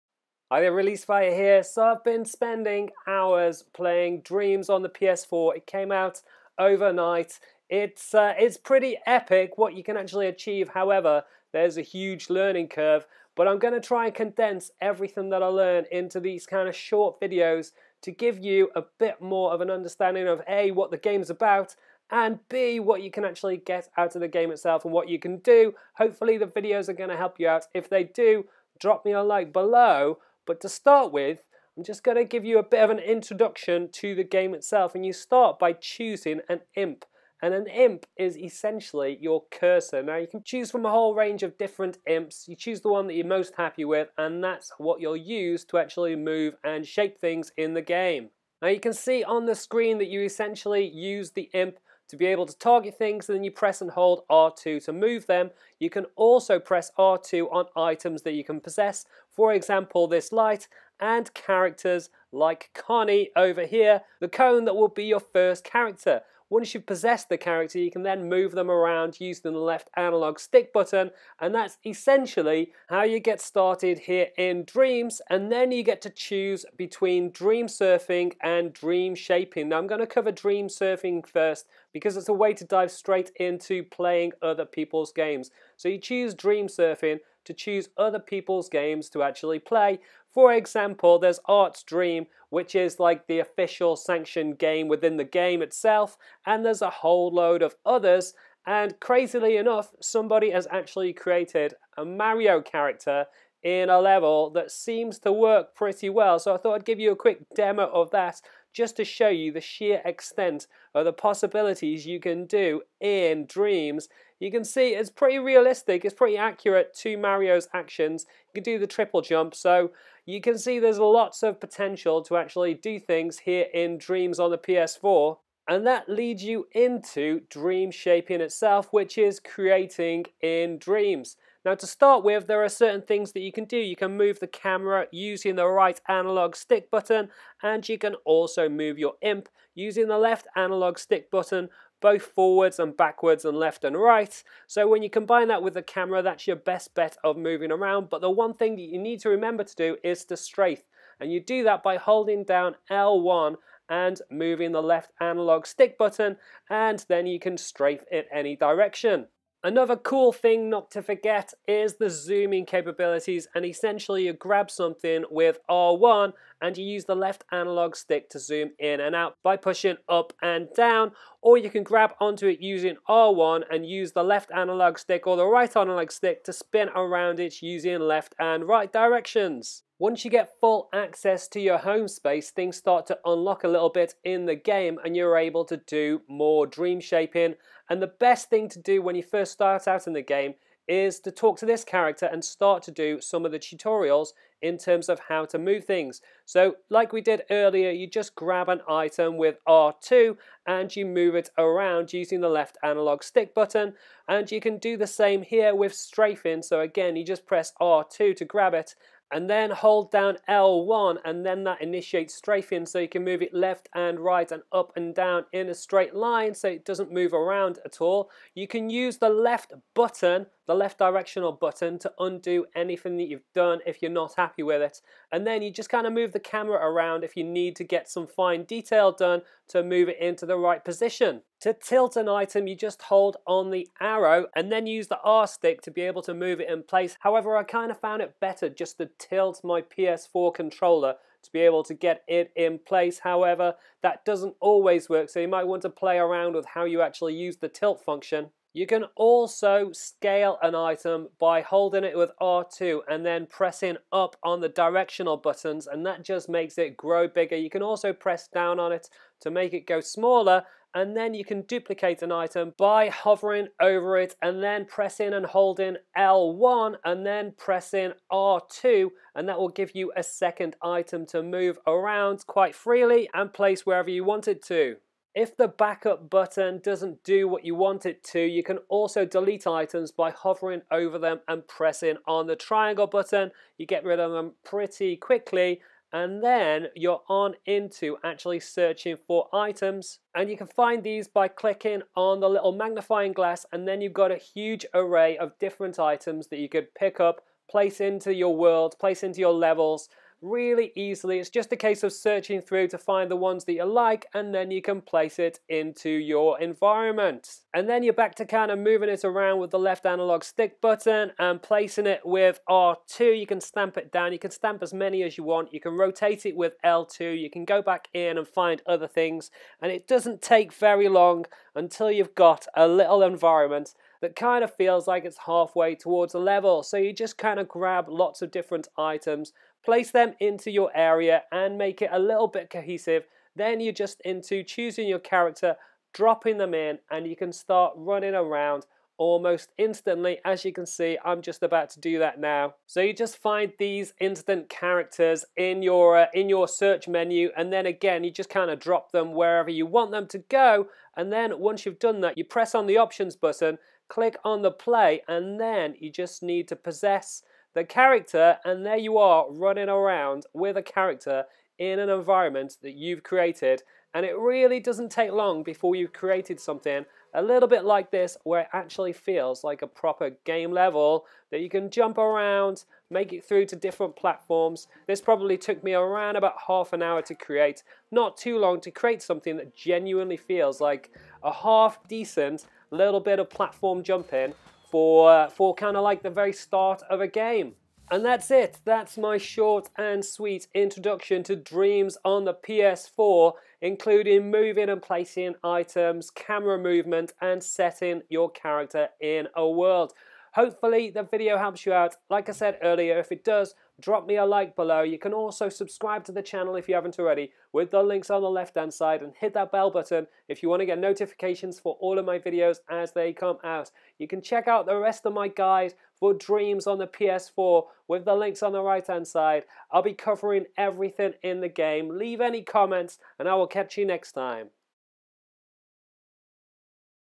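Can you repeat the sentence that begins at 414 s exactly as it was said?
You can check out the rest of my guides for Dreams on the PS4 with the links on the right hand side.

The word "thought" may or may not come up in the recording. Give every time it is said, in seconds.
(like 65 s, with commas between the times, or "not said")
106 s.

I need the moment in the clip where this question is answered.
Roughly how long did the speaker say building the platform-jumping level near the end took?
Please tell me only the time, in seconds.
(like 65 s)
376 s.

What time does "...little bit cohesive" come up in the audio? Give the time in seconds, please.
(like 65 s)
332 s.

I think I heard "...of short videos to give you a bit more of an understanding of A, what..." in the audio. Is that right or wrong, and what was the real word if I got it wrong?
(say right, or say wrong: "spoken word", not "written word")
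right.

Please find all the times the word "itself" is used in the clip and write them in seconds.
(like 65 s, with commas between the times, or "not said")
24 s, 34 s, 95 s, 128 s.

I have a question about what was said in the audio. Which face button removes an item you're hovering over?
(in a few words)
Triangle.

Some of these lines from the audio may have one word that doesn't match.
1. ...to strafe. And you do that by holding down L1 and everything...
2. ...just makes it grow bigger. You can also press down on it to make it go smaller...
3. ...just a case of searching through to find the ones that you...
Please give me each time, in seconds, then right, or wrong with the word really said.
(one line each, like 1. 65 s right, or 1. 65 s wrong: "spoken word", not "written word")
1. 150 s wrong: "moving", not "everything"
2. 256 s right
3. 301 s right.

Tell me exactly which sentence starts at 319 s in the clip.
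And it doesn't take very long until you've got a little environment that kind of feels like it's halfway towards a level.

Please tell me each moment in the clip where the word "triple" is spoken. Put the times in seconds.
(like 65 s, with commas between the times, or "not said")
118 s.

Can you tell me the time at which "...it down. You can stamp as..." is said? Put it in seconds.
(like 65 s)
313 s.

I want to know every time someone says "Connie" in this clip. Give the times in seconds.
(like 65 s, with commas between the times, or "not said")
62 s.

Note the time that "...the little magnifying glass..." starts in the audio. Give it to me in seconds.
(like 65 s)
292 s.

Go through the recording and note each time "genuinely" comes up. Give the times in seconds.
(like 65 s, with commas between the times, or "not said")
379 s.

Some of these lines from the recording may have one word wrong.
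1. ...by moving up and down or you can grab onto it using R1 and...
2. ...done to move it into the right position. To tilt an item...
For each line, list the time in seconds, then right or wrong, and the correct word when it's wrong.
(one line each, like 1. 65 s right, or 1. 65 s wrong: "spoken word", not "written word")
1. 169 s wrong: "pushing", not "moving"
2. 229 s right.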